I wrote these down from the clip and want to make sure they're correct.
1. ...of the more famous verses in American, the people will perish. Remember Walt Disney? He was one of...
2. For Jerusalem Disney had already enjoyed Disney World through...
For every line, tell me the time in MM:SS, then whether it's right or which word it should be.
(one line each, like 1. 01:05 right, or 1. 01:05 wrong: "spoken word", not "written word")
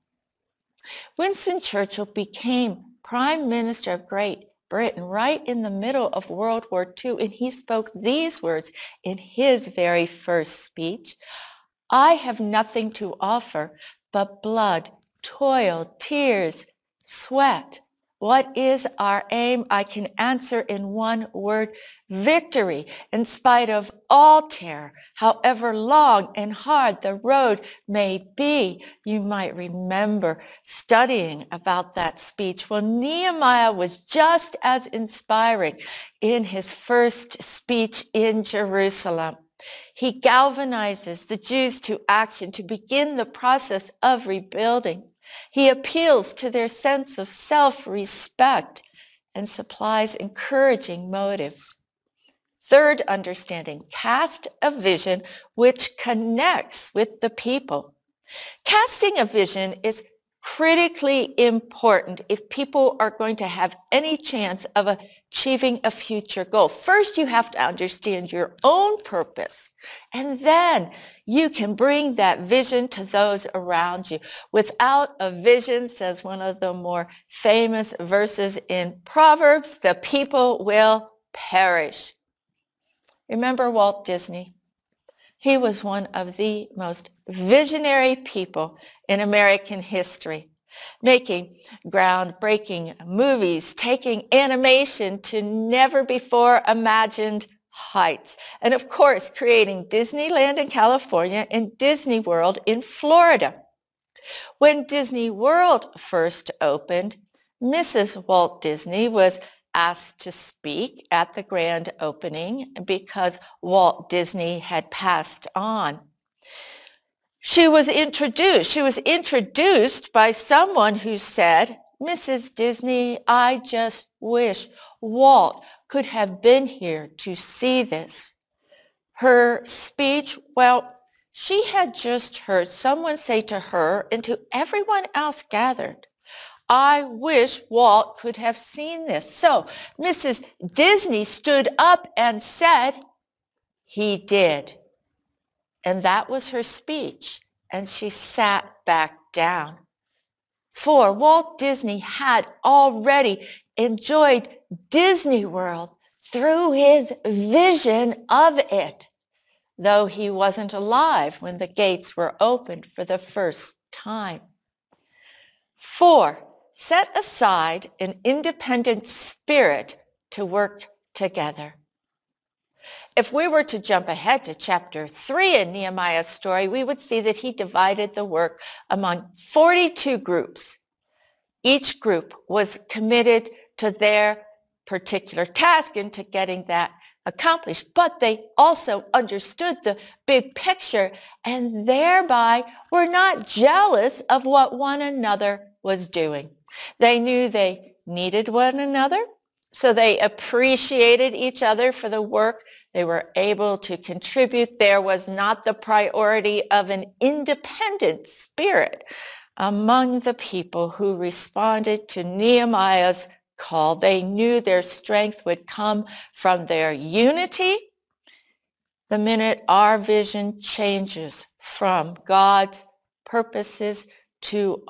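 1. 01:16 wrong: "Proverbs", not "American"
2. 02:30 wrong: "Walt", not "Jerusalem".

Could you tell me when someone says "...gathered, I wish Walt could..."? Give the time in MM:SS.
02:15.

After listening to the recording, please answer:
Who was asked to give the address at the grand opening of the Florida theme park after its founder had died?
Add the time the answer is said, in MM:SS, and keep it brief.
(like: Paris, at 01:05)
Mrs. Walt Disney, at 01:47.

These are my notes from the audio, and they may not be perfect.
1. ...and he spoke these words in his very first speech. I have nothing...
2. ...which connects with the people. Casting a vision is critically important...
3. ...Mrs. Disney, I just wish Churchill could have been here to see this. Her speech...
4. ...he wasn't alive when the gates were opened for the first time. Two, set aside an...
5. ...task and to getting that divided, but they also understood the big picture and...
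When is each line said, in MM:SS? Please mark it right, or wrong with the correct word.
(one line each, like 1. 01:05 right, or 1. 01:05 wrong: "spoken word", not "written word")
1. 00:07 right
2. 00:55 right
3. 02:01 wrong: "Walt", not "Churchill"
4. 02:40 wrong: "Four", not "Two"
5. 03:05 wrong: "accomplished", not "divided".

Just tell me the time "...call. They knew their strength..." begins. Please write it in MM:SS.
03:33.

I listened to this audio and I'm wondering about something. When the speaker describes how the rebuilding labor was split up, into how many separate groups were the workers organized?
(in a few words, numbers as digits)
42.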